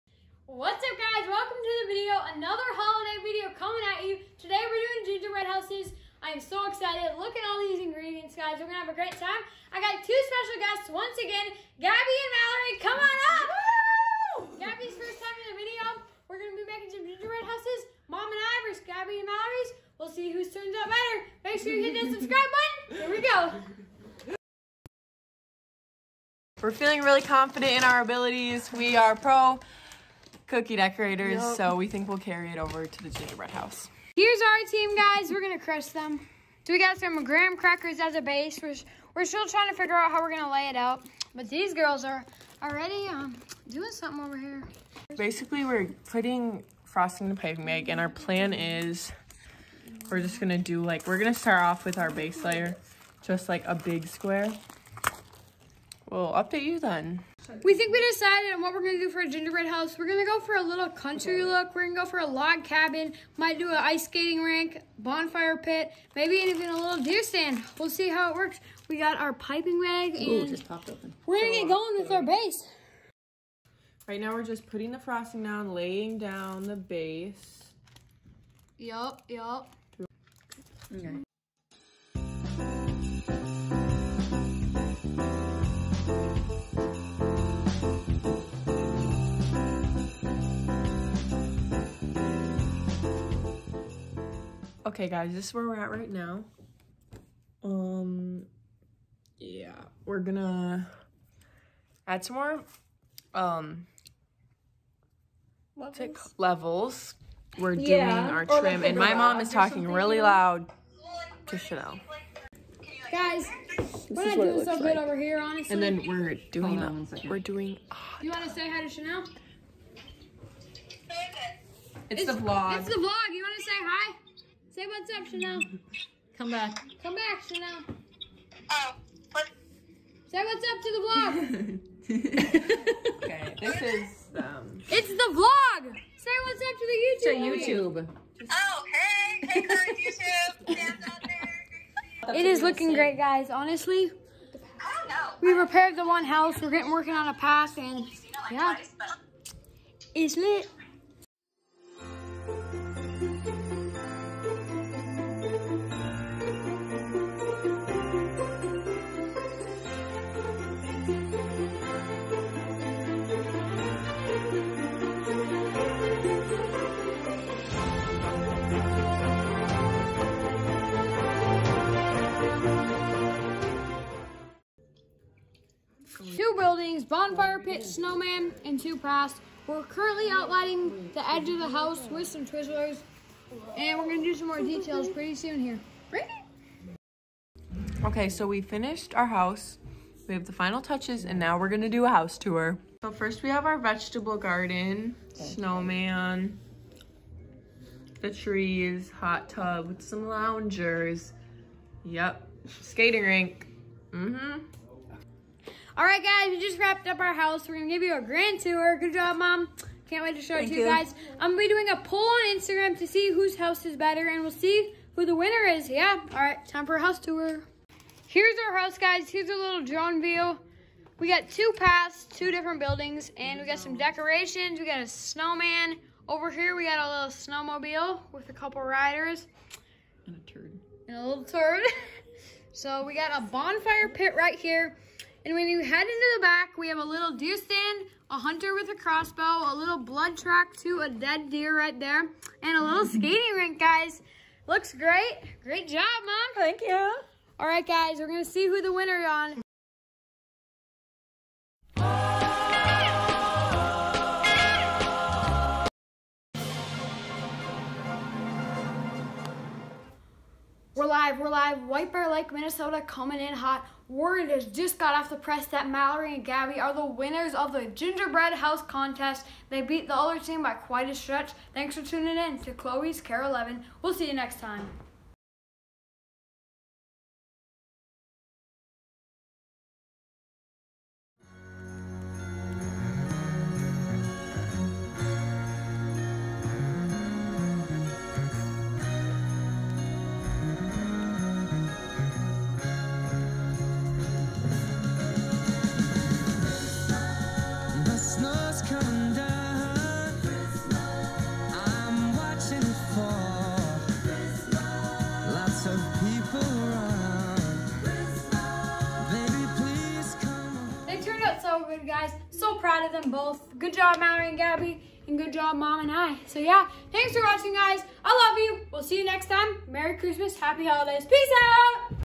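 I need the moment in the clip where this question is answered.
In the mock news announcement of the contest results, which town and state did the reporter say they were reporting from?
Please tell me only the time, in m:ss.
4:21.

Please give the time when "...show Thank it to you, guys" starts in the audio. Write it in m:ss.
3:30.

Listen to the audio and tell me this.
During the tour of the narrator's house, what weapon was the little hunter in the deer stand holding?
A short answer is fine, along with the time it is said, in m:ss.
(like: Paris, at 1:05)
Crossbow, at 3:58.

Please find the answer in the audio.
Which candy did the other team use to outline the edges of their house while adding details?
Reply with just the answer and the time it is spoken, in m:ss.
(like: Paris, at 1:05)
Twizzlers, at 3:02.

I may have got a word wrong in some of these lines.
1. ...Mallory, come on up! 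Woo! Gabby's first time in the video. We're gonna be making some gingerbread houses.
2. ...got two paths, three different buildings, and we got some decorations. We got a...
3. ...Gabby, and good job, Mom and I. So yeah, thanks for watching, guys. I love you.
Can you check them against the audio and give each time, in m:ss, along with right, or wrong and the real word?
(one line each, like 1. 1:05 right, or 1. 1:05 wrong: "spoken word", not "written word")
1. 0:12 right
2. 3:41 wrong: "two", not "three"
3. 5:14 right.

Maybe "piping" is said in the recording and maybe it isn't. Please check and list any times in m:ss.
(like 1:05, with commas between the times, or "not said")
0:47, 1:09.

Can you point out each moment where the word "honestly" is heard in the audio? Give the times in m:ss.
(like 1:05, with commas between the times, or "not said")
1:55, 2:23.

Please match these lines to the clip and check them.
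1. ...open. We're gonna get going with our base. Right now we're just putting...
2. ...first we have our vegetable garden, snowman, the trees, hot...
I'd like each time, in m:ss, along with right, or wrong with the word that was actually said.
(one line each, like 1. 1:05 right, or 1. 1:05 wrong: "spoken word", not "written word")
1. 1:10 right
2. 3:13 right.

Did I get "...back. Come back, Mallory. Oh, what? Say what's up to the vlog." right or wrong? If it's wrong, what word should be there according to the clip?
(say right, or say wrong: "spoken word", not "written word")
wrong: "Chanel", not "Mallory".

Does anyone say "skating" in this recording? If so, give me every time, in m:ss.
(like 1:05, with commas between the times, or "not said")
1:04, 3:22, 4:03.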